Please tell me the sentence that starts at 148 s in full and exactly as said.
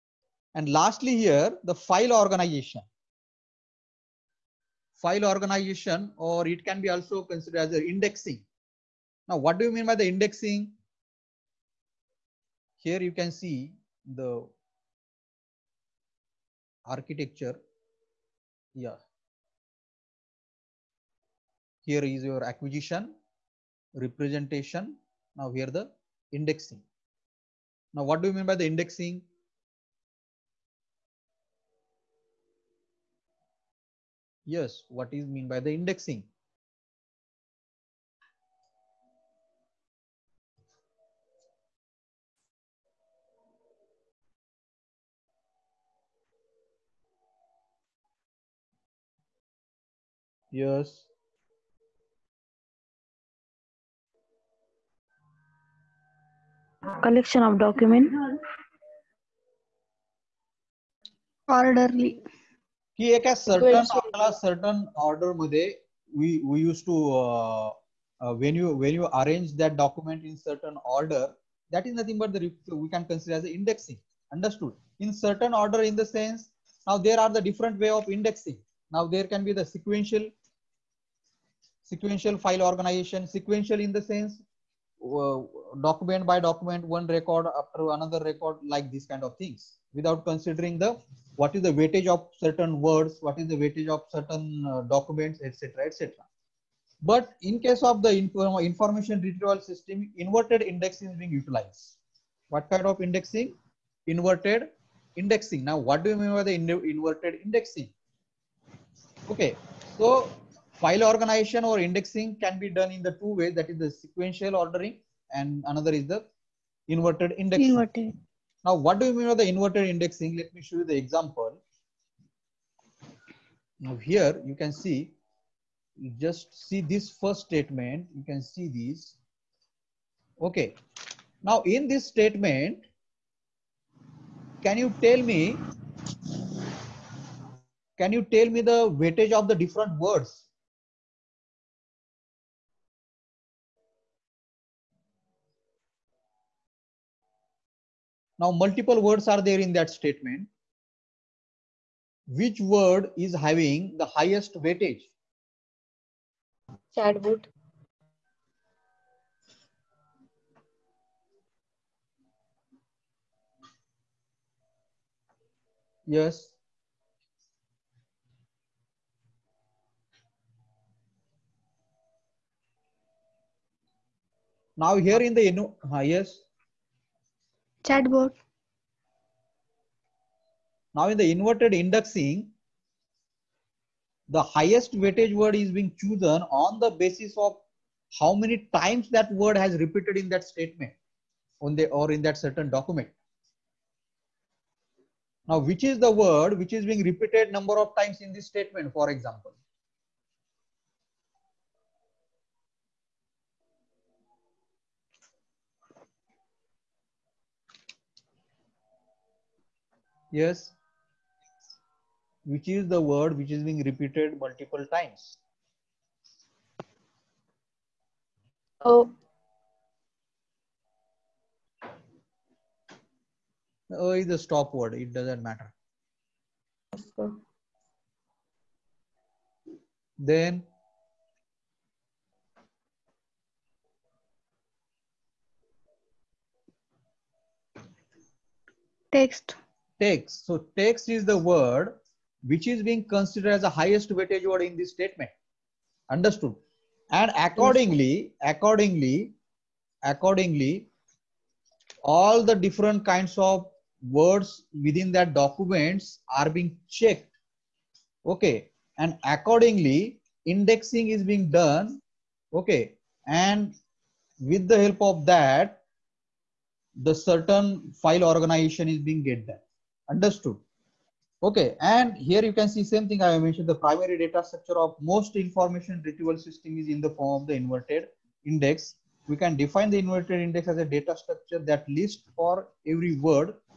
Now multiple words are there in that statement.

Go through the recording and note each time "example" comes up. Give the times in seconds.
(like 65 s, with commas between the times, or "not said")
120 s, 199 s.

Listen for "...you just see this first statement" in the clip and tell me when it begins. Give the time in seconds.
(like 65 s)
125 s.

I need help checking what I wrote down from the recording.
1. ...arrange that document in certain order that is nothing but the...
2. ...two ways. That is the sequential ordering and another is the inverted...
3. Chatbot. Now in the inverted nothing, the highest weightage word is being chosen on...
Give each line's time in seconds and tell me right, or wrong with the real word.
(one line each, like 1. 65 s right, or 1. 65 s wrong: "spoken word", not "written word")
1. 69 s right
2. 113 s right
3. 177 s wrong: "indexing", not "nothing".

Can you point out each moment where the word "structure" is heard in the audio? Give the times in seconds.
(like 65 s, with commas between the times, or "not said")
274 s, 281 s.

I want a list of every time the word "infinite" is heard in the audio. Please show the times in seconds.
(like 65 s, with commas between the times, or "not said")
not said.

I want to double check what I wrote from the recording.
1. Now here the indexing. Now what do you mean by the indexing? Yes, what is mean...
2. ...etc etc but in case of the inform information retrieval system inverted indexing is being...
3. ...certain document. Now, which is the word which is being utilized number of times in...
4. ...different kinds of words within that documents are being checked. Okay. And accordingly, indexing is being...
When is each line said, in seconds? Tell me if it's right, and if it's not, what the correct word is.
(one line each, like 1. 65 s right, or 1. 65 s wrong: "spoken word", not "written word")
1. 25 s right
2. 95 s right
3. 192 s wrong: "repeated", not "utilized"
4. 252 s right.